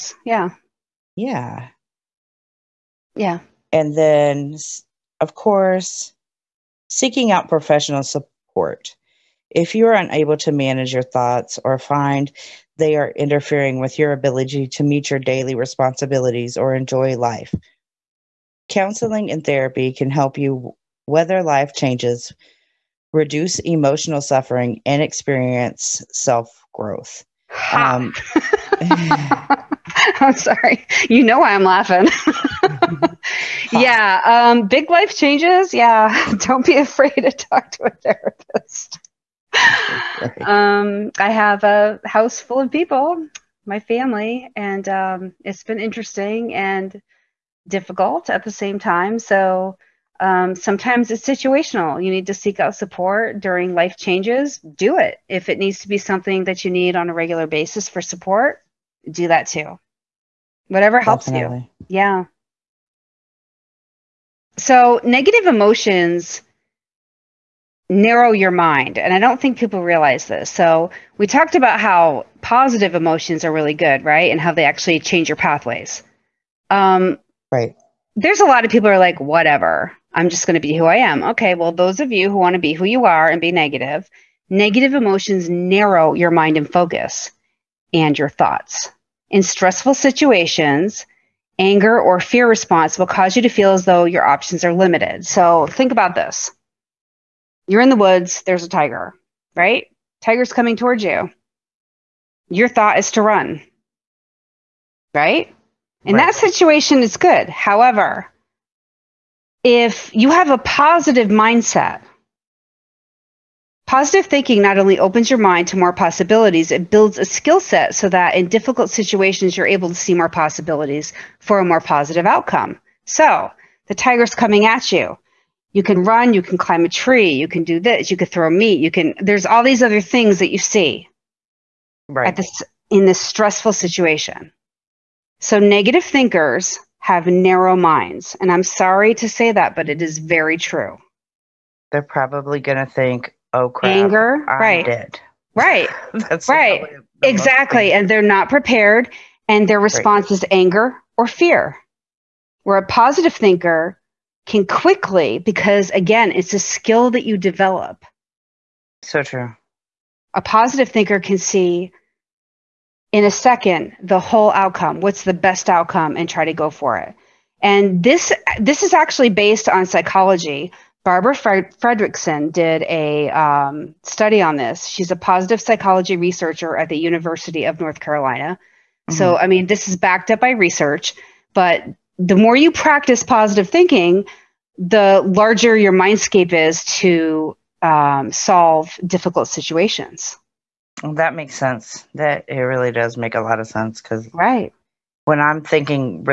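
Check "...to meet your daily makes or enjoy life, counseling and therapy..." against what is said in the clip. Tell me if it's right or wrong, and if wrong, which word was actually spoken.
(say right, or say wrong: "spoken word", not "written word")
wrong: "responsibilities", not "makes".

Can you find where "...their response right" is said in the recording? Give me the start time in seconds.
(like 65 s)
149 s.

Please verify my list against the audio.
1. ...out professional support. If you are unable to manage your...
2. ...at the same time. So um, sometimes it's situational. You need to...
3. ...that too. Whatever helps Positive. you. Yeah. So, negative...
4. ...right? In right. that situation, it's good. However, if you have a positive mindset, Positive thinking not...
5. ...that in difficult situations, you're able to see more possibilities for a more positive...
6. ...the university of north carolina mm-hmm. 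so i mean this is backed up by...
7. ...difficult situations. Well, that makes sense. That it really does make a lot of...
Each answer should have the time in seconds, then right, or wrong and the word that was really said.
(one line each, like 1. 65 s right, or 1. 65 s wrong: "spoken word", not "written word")
1. 7 s right
2. 48 s right
3. 59 s wrong: "Definitely", not "Positive"
4. 105 s right
5. 118 s right
6. 176 s right
7. 189 s right.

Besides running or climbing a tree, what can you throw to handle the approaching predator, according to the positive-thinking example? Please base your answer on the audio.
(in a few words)
Meat.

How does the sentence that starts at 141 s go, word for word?
They're probably going to think, "Oh crap, anger, I'm right.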